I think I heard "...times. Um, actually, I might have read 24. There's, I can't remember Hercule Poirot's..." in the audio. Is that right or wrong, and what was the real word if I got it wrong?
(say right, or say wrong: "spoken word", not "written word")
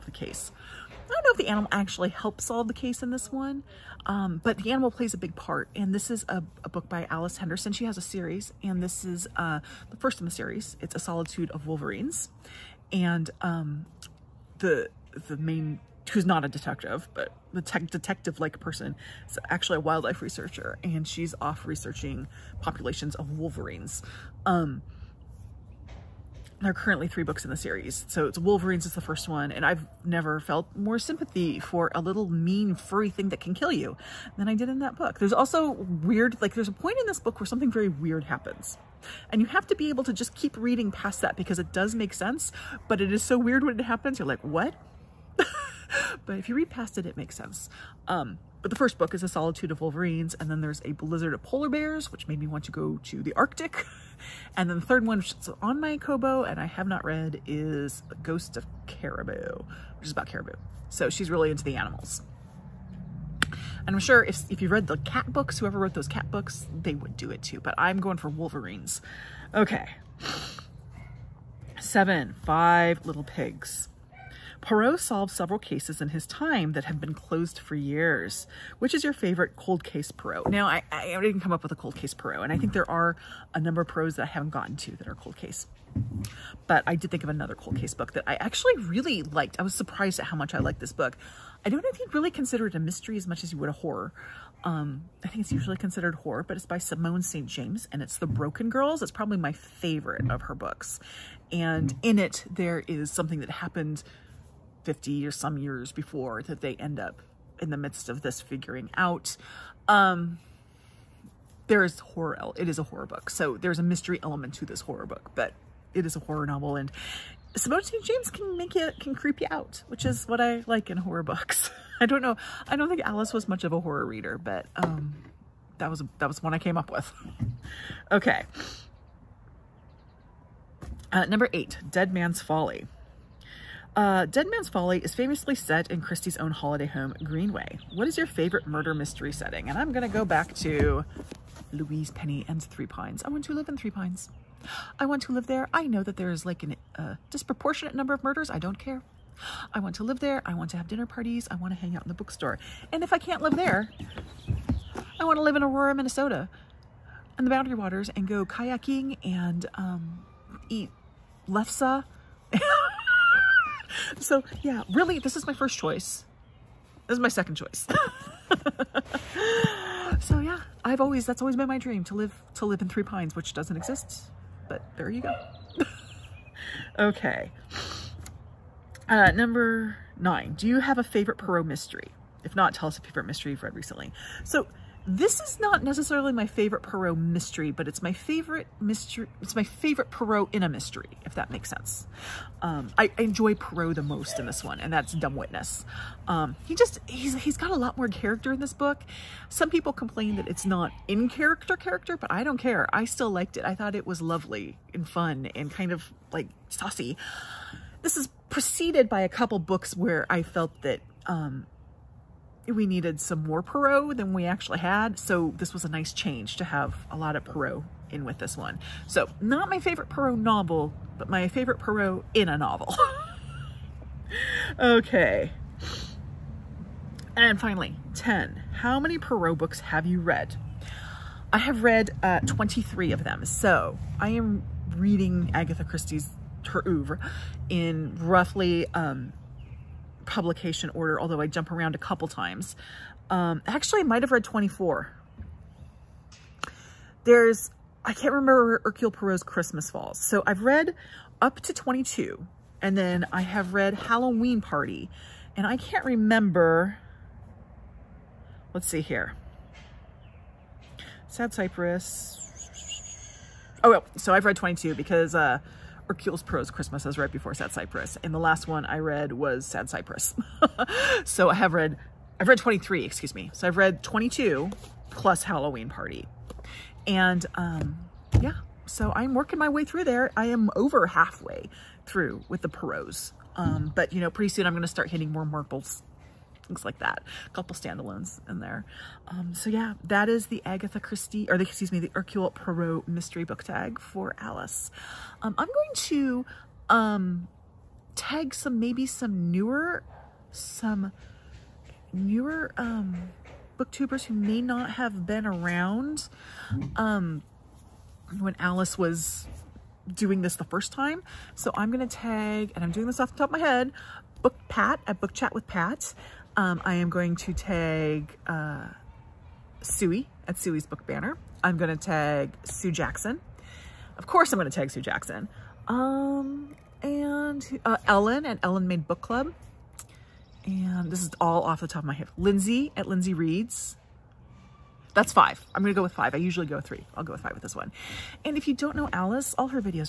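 right.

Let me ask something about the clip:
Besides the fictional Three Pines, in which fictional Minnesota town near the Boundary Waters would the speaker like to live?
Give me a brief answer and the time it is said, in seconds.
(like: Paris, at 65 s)
Aurora, at 155 s.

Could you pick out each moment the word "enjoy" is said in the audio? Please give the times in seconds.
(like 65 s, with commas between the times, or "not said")
193 s.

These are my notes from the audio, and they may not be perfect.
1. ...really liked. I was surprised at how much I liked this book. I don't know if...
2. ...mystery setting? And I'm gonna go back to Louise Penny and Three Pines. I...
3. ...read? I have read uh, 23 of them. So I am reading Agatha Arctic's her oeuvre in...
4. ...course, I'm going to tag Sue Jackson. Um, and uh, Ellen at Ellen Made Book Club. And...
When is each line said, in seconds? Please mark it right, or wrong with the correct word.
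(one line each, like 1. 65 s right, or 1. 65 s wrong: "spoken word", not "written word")
1. 88 s right
2. 138 s right
3. 230 s wrong: "Christie", not "Arctic"
4. 324 s right.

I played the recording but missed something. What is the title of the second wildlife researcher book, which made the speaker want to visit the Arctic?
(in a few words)
A Blizzard of Polar Bears.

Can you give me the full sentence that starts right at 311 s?
So I'm going to tag, and I'm doing this off the top of my head, Book Pat at Book Chat with Pat.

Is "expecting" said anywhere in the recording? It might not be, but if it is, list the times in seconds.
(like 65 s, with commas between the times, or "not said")
not said.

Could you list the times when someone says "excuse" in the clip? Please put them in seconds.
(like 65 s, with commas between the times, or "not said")
273 s, 291 s.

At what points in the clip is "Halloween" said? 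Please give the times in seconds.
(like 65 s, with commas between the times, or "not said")
253 s, 275 s.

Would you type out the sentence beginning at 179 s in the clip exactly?
Uh, number nine, do you have a favorite Poirot mystery?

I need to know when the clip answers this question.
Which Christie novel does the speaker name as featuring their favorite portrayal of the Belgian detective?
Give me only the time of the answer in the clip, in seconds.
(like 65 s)
195 s.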